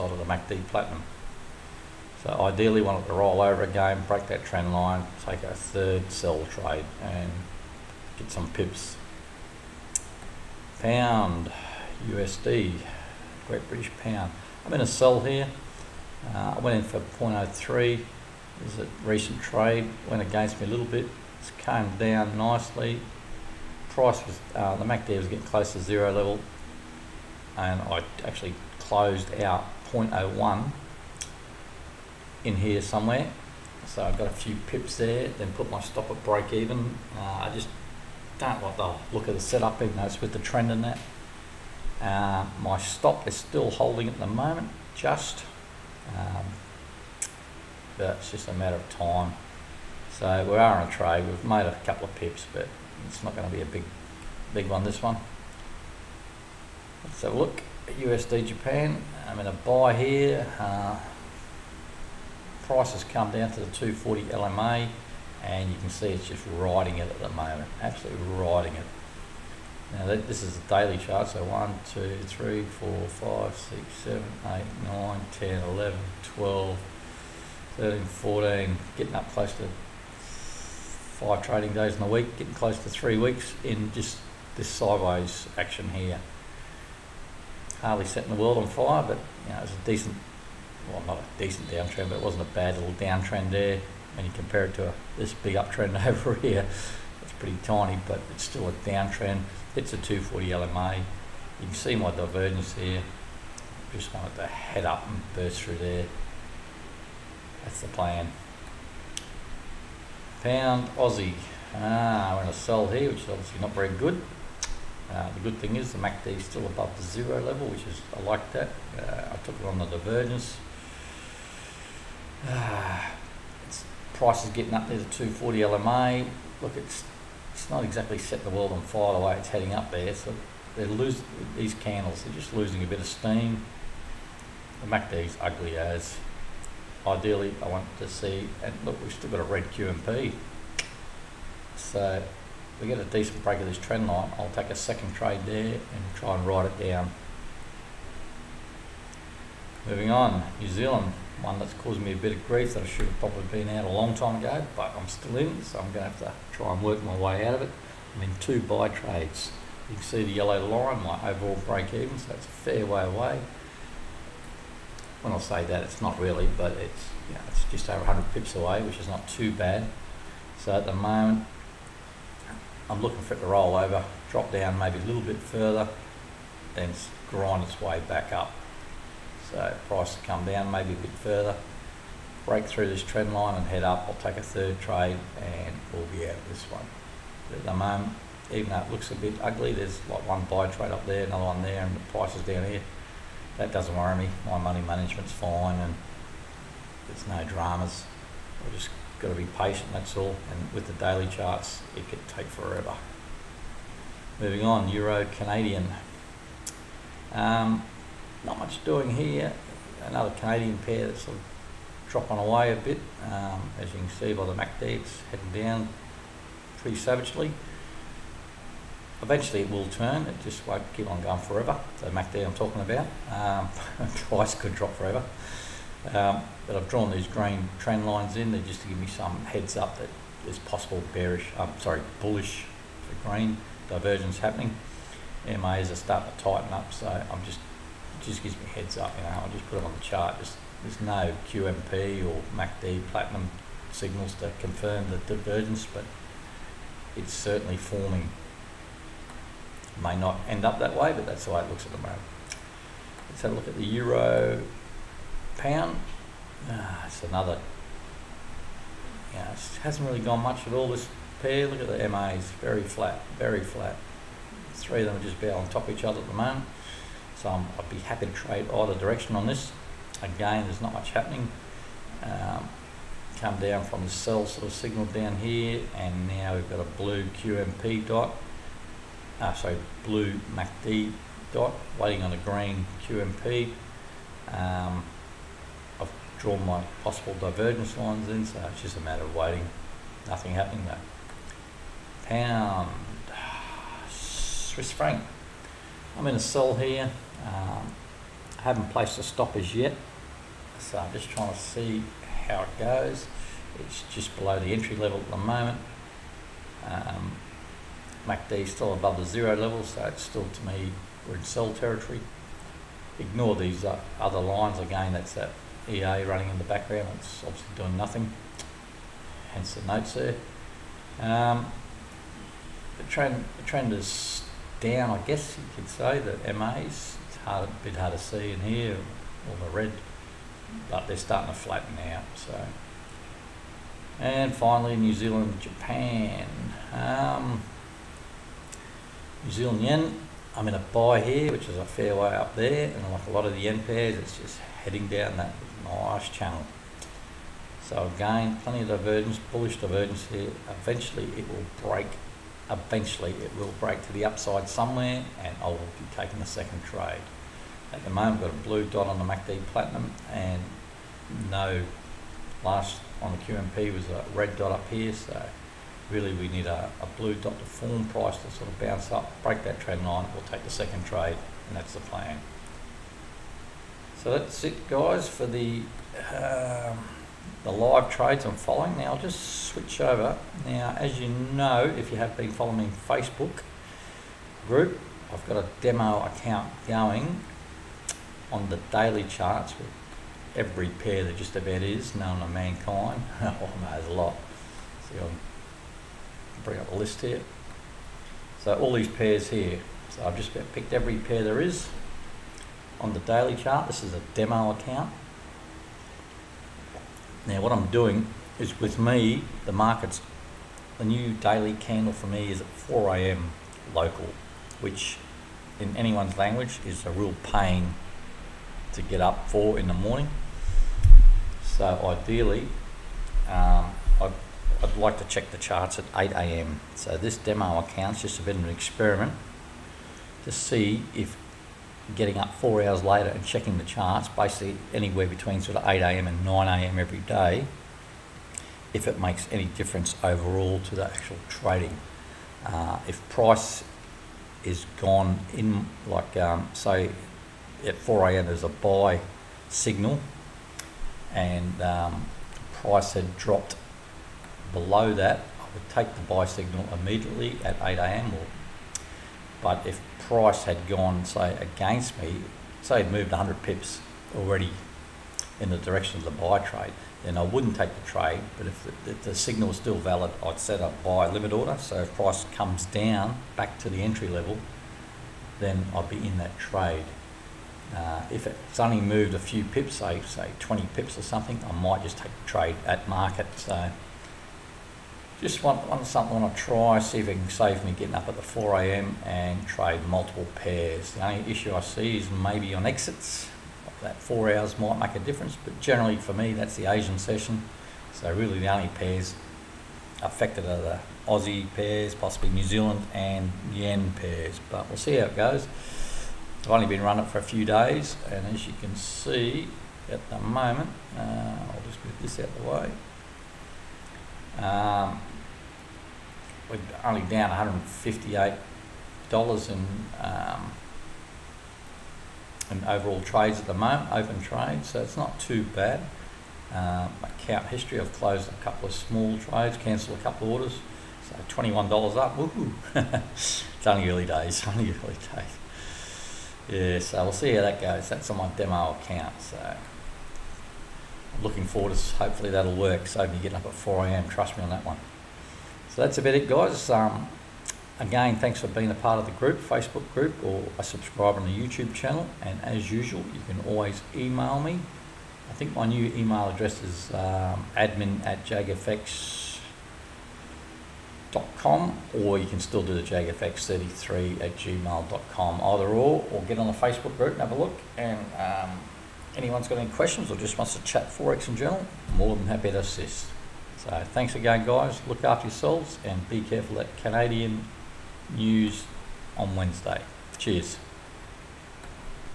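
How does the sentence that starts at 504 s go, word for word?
But we'll see how it goes.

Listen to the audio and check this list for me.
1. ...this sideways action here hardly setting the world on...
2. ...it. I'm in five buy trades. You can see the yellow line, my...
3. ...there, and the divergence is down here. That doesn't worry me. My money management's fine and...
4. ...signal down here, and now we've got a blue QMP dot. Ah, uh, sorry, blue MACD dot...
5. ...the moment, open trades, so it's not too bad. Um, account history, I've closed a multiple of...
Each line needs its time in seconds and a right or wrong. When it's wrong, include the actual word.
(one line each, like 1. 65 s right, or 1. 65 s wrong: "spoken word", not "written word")
1. 84 s right
2. 157 s wrong: "two", not "five"
3. 191 s wrong: "price", not "divergence"
4. 274 s right
5. 523 s wrong: "couple", not "multiple".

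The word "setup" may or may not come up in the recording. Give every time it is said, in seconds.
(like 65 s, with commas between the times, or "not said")
39 s.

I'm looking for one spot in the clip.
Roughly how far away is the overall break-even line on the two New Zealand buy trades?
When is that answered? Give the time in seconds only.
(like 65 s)
167 s.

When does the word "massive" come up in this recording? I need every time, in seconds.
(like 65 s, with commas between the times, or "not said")
not said.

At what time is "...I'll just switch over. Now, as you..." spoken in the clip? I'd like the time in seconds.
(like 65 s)
379 s.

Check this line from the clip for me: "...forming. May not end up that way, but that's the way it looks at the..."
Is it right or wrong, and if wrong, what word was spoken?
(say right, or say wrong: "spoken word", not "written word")
right.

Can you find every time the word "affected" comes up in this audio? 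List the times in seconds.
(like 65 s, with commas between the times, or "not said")
500 s.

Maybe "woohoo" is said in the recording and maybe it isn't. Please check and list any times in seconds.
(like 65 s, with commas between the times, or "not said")
532 s.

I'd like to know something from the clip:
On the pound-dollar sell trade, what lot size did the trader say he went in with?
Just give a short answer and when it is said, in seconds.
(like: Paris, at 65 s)
0.03, at 17 s.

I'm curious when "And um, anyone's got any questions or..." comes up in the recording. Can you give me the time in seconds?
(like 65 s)
567 s.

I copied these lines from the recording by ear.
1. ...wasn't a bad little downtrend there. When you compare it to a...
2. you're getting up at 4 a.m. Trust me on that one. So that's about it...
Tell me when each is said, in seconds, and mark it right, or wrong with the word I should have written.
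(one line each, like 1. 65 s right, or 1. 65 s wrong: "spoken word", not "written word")
1. 92 s right
2. 543 s right.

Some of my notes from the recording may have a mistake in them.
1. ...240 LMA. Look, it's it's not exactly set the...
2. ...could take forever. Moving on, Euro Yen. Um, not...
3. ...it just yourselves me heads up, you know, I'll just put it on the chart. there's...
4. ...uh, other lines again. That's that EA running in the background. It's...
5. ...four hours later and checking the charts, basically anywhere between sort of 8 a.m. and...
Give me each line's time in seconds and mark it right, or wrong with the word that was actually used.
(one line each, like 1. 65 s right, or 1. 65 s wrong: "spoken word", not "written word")
1. 125 s right
2. 202 s wrong: "Canadian", not "Yen"
3. 238 s wrong: "gives", not "yourselves"
4. 313 s right
5. 432 s right.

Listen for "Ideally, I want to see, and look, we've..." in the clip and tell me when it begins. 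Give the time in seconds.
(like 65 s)
137 s.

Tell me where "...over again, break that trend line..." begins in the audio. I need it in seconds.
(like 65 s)
3 s.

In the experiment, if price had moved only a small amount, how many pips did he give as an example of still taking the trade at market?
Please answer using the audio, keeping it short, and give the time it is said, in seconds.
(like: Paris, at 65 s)
20 pips, at 480 s.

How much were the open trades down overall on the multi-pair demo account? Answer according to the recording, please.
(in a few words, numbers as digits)
$158.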